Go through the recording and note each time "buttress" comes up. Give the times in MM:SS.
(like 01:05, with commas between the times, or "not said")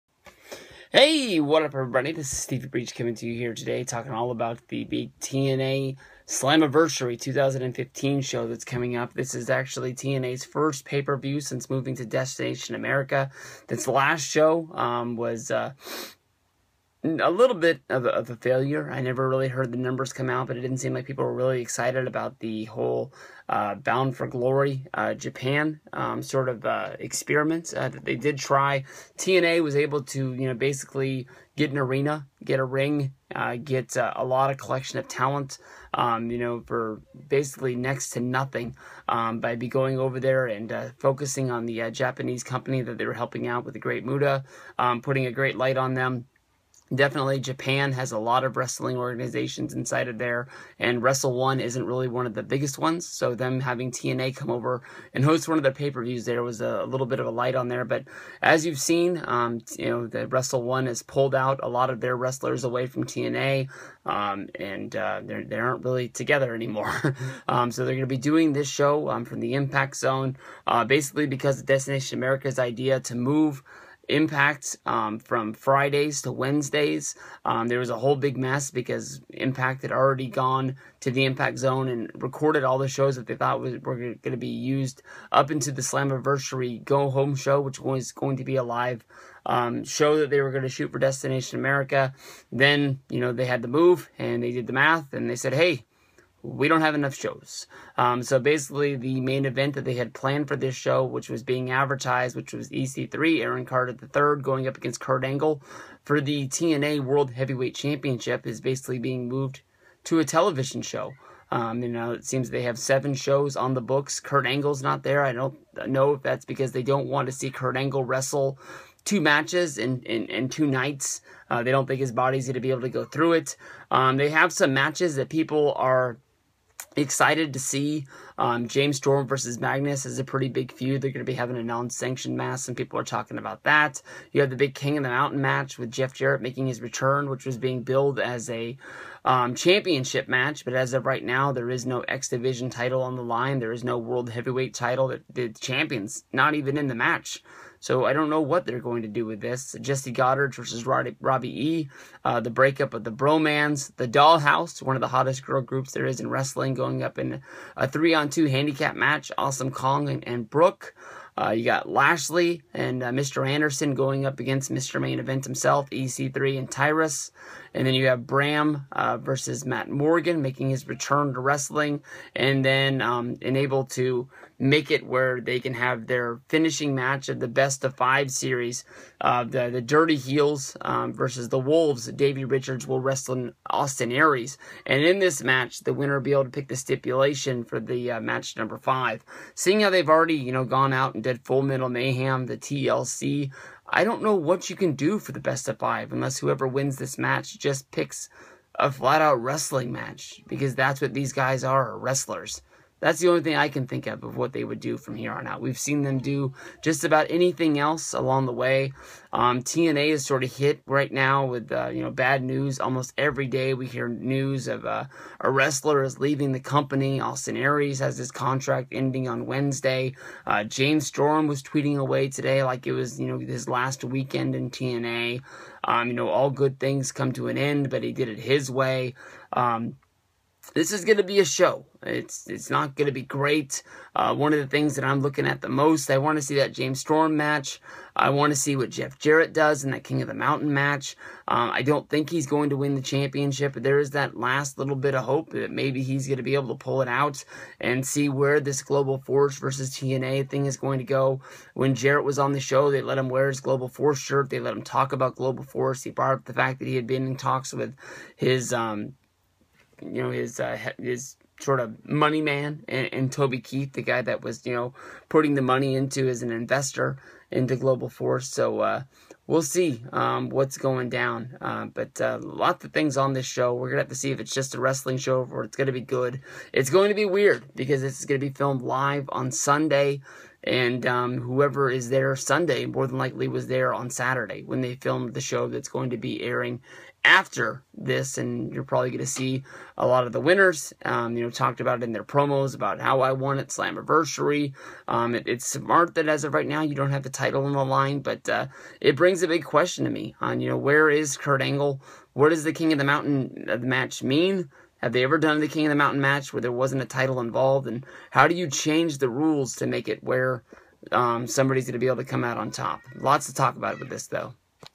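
not said.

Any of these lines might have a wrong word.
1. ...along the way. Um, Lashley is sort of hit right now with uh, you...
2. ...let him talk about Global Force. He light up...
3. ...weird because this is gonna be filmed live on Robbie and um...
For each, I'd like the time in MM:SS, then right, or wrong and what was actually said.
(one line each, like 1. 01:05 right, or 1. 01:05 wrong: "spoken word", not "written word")
1. 03:28 wrong: "TNA", not "Lashley"
2. 04:14 wrong: "brought", not "light"
3. 04:37 wrong: "Sunday", not "Robbie".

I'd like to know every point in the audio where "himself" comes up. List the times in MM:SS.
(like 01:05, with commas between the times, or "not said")
02:45.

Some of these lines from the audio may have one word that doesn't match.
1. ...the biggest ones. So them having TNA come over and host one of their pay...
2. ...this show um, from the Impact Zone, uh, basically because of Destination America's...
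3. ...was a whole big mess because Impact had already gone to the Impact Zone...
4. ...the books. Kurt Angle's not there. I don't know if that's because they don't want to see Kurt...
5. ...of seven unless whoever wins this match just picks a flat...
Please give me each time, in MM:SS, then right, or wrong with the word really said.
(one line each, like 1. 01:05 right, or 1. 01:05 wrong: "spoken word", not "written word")
1. 00:52 right
2. 01:08 right
3. 01:17 right
4. 01:53 right
5. 03:15 wrong: "five", not "seven".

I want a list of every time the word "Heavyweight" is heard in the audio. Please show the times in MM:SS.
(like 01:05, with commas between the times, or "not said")
01:47, 02:24.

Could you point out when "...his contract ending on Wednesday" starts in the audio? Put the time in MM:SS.
03:38.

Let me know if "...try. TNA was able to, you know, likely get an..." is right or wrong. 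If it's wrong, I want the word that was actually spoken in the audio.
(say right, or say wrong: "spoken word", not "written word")
wrong: "basically", not "likely".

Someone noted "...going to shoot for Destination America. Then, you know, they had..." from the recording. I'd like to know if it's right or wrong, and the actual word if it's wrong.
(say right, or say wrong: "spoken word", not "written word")
right.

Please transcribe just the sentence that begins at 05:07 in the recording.
And how do you change the rules to make it where um, somebody's going to be able to come out on top?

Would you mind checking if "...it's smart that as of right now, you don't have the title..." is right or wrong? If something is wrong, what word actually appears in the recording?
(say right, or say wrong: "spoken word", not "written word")
right.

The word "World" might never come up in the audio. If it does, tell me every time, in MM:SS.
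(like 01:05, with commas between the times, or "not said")
01:47, 02:23.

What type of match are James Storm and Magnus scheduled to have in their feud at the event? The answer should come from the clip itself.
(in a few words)
non-sanctioned match.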